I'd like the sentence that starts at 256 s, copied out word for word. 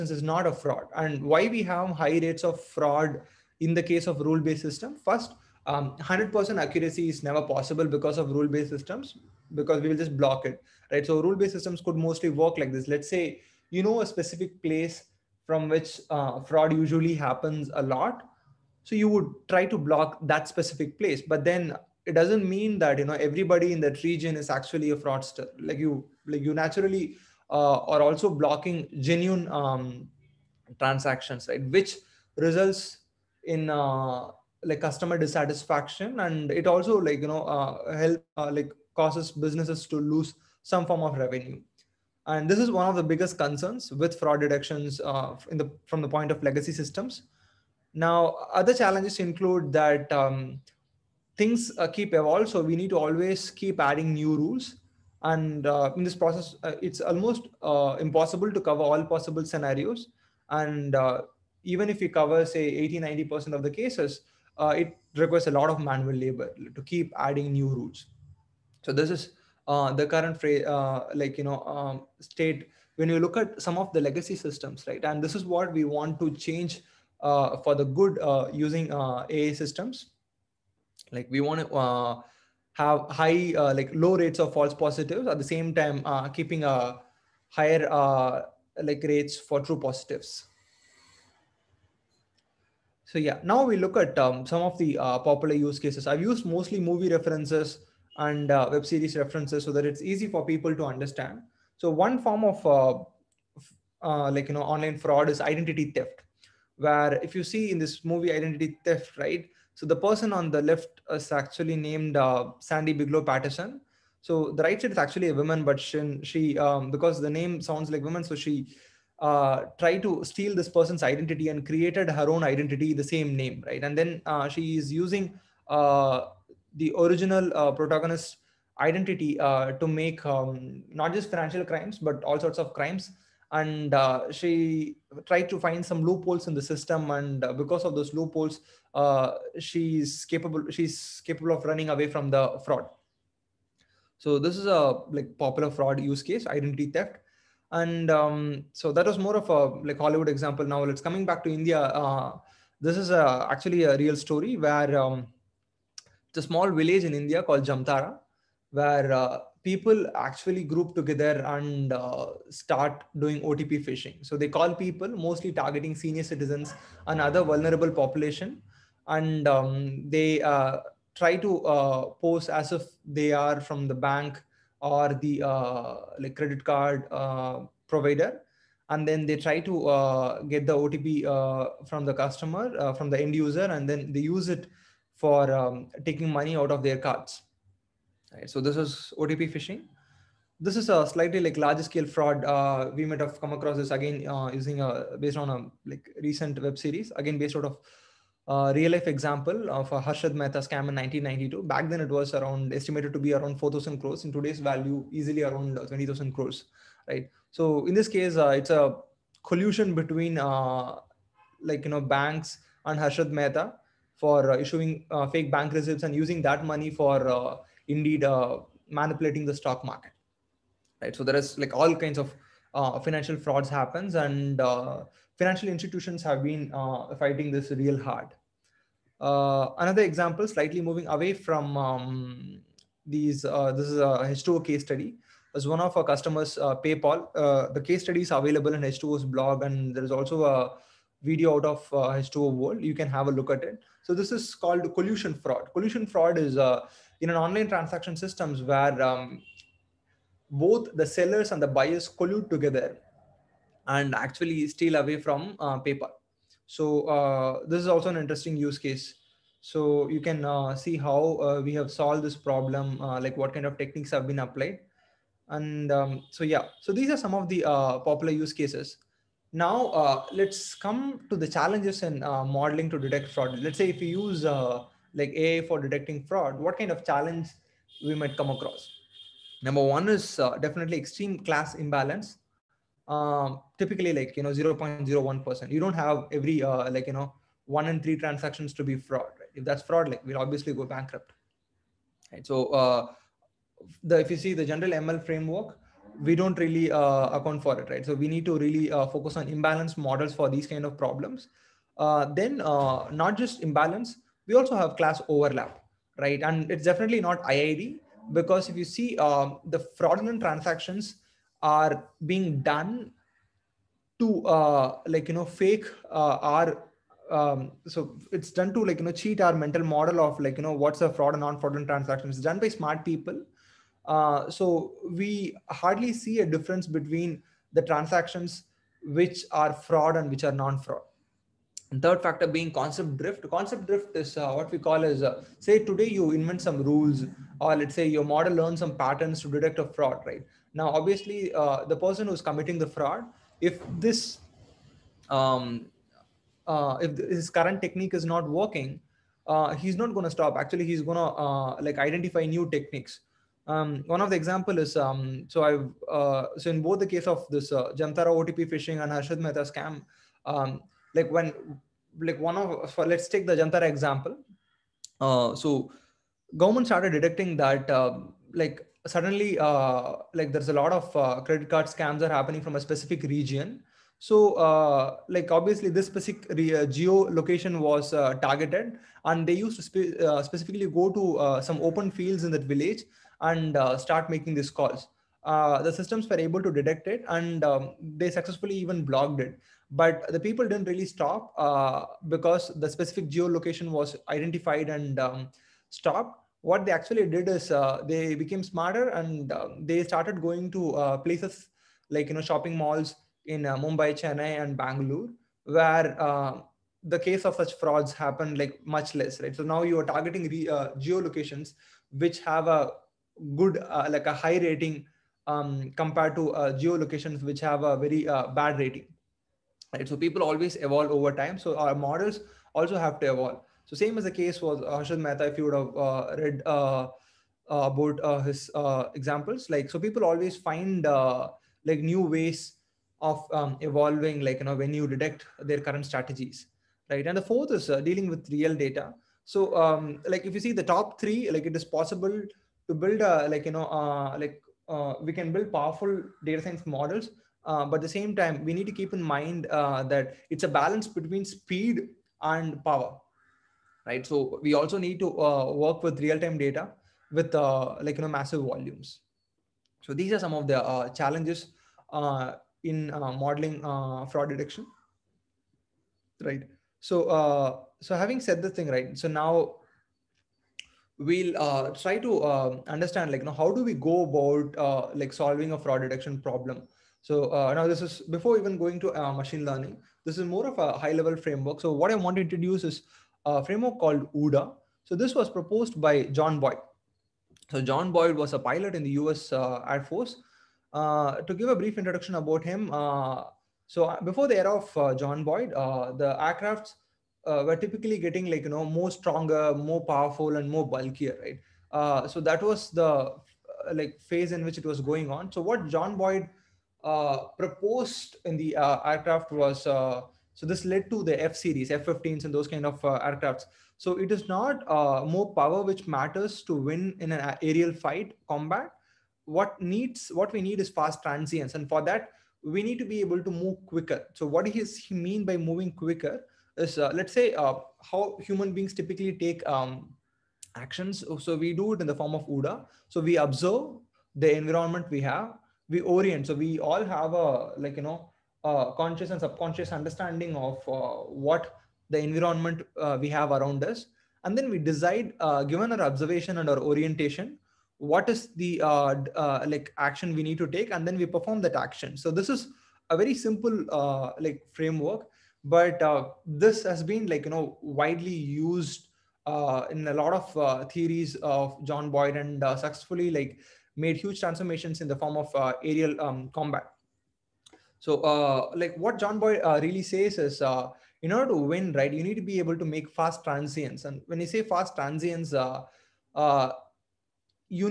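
So uh, this is also an interesting use case.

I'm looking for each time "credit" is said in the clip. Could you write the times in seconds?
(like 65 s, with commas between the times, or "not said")
176 s, 371 s.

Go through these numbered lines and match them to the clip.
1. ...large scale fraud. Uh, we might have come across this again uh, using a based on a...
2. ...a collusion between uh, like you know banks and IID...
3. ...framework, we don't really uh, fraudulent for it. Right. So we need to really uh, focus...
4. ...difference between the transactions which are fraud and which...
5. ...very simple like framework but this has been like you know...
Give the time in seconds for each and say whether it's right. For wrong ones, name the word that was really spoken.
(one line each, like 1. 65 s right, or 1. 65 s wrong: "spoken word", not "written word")
1. 191 s right
2. 208 s wrong: "Harshad", not "IID"
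3. 295 s wrong: "account", not "fraudulent"
4. 326 s right
5. 553 s right.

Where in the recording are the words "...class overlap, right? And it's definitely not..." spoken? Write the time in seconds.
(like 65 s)
304 s.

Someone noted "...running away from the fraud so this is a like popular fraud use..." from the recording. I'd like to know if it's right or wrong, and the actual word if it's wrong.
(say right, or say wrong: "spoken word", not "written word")
right.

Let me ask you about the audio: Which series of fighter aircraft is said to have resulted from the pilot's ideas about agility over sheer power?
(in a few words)
F series.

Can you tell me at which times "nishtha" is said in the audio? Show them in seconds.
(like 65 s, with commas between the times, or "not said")
not said.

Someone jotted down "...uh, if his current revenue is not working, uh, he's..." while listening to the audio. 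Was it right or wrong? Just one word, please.
wrong.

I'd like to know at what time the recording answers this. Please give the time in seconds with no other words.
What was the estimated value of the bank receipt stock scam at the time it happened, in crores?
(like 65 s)
203 s.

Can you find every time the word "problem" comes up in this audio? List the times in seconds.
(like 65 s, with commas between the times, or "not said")
262 s, 300 s, 476 s.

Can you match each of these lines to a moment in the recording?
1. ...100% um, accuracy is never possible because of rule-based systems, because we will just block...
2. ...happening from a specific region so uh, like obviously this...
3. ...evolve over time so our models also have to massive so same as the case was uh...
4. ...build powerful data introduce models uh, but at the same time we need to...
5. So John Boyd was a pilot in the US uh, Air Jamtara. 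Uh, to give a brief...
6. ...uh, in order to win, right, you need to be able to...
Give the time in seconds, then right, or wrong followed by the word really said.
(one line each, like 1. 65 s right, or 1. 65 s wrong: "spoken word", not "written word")
1. 5 s right
2. 372 s right
3. 420 s wrong: "evolve", not "massive"
4. 445 s wrong: "science", not "introduce"
5. 487 s wrong: "Force", not "Jamtara"
6. 570 s right.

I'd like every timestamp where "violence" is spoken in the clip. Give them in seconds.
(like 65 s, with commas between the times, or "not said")
not said.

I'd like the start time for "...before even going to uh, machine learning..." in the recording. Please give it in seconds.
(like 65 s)
478 s.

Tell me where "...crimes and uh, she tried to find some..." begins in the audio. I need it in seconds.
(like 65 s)
132 s.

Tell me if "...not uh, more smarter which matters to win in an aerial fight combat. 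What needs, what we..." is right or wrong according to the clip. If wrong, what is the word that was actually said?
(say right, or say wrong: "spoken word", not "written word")
wrong: "power", not "smarter".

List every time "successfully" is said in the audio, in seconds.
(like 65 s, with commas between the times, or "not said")
388 s, 562 s.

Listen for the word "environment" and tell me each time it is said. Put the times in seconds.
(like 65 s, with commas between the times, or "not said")
534 s, 542 s.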